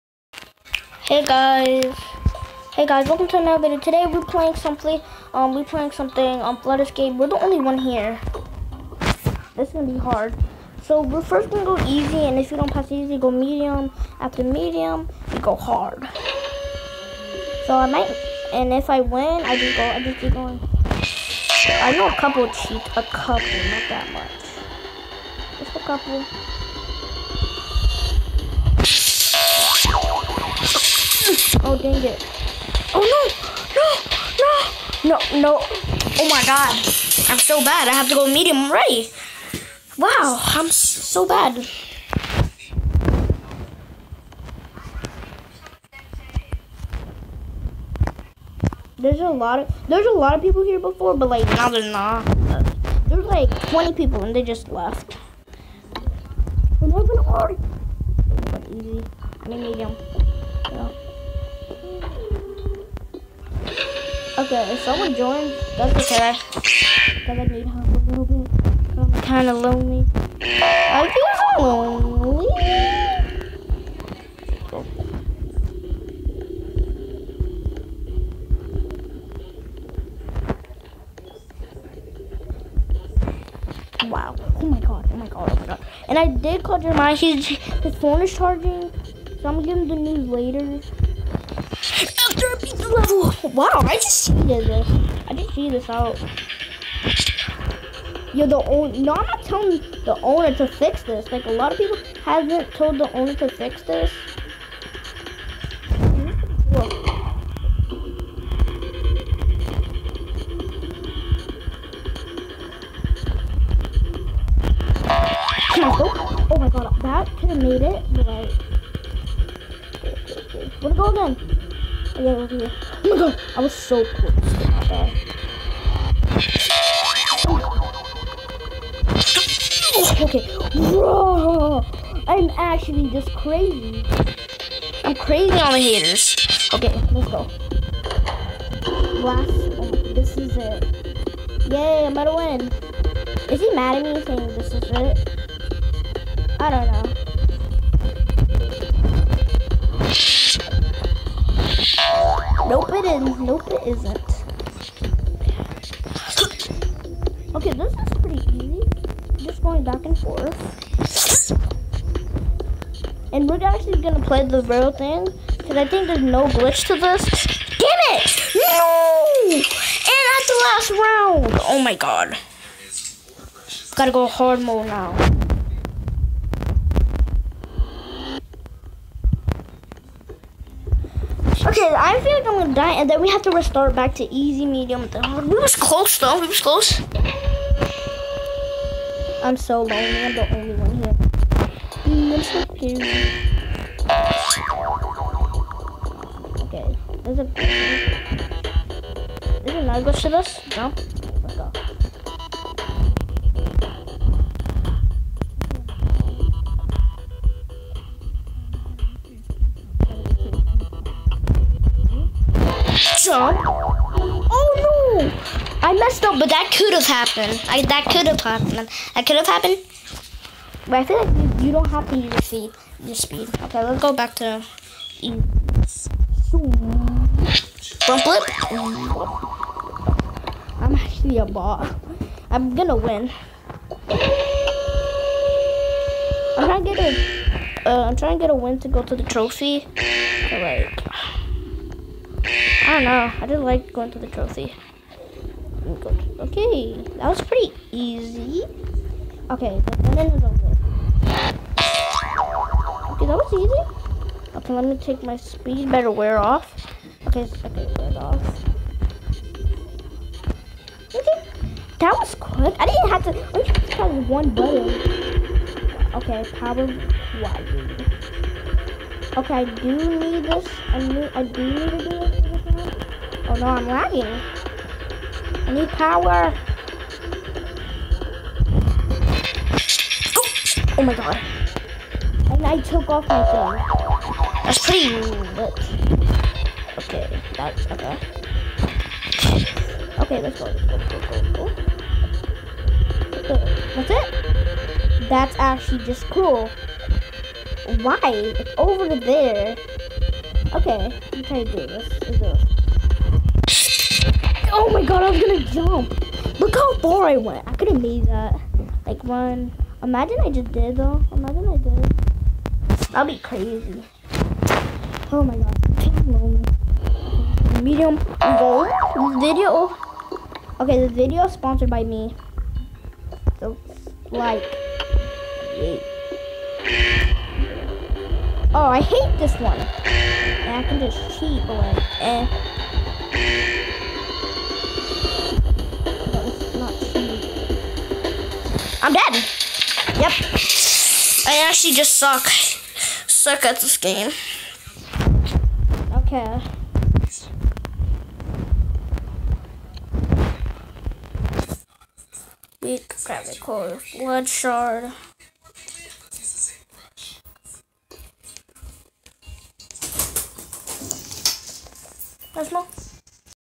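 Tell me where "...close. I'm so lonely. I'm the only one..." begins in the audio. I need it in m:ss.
3:06.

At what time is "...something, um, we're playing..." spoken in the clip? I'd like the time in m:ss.
0:04.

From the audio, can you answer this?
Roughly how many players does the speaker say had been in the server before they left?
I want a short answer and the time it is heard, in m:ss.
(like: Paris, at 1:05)
20, at 0:53.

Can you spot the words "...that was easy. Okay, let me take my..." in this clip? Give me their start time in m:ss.
4:10.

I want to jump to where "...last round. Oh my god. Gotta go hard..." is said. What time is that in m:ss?
2:50.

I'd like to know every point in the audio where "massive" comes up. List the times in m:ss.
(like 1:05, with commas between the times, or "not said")
not said.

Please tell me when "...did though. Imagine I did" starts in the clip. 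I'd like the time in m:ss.
5:10.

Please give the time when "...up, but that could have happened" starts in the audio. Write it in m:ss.
3:36.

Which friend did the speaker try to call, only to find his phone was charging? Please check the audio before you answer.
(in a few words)
Jeremiah.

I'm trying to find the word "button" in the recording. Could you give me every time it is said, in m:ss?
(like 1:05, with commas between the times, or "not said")
4:24.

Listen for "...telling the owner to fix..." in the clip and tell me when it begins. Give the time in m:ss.
1:39.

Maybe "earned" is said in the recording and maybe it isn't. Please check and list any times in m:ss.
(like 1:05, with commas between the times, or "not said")
not said.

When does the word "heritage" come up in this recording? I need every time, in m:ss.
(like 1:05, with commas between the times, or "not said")
not said.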